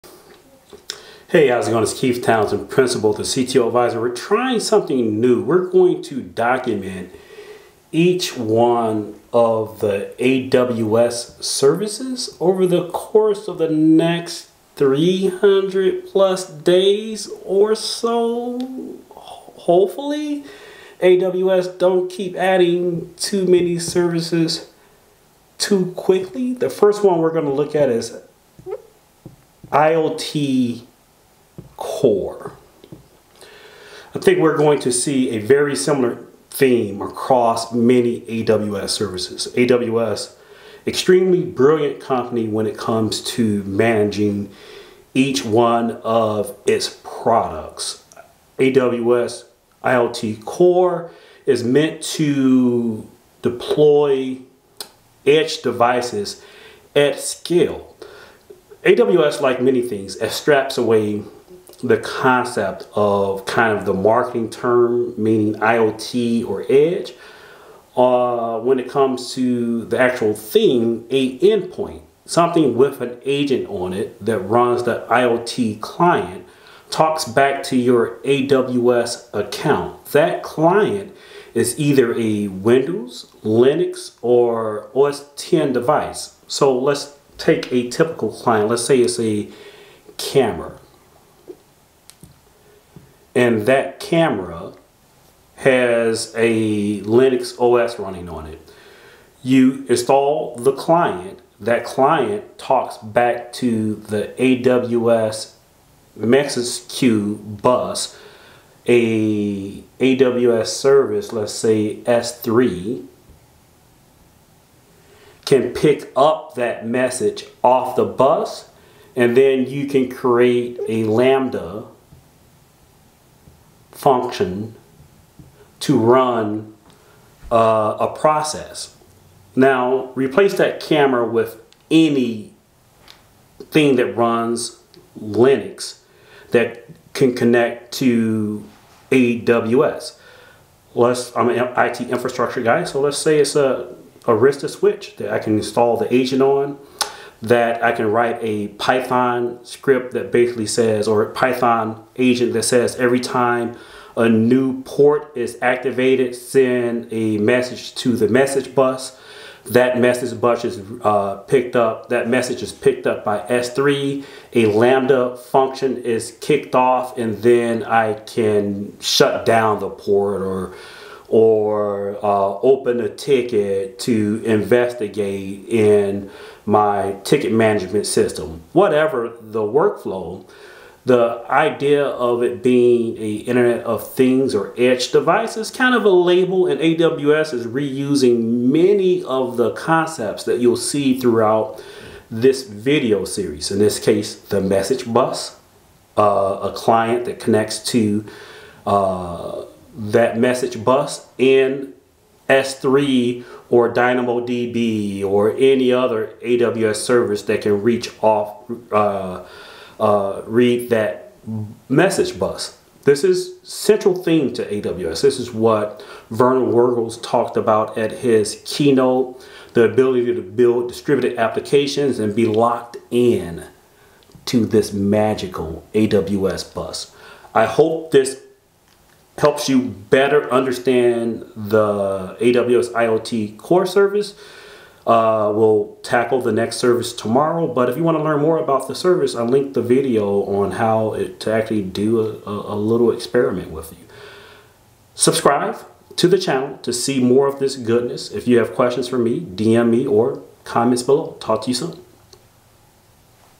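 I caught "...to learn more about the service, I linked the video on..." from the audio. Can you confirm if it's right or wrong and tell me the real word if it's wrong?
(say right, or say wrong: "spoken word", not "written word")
right.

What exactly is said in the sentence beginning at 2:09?
Now, replace that camera with any thing that runs Linux that can connect to AWS.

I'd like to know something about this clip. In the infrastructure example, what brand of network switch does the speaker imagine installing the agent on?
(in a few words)
Arista.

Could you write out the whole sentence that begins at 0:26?
The first one we're going to look at is IoT core.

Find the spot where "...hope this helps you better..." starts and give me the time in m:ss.
3:47.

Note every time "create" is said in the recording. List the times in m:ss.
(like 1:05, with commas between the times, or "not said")
2:00.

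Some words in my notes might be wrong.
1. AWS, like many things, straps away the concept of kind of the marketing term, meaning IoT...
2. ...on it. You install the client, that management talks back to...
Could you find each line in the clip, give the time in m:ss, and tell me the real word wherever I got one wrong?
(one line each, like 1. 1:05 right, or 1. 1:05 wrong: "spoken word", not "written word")
1. 0:58 right
2. 1:38 wrong: "client", not "management".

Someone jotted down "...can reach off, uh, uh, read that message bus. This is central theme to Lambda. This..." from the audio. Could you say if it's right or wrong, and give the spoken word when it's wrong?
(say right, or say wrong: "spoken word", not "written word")
wrong: "AWS", not "Lambda".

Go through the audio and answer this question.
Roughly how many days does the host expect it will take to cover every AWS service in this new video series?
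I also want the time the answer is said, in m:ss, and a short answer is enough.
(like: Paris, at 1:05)
300, at 0:14.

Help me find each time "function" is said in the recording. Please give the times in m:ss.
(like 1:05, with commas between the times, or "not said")
2:04, 2:45.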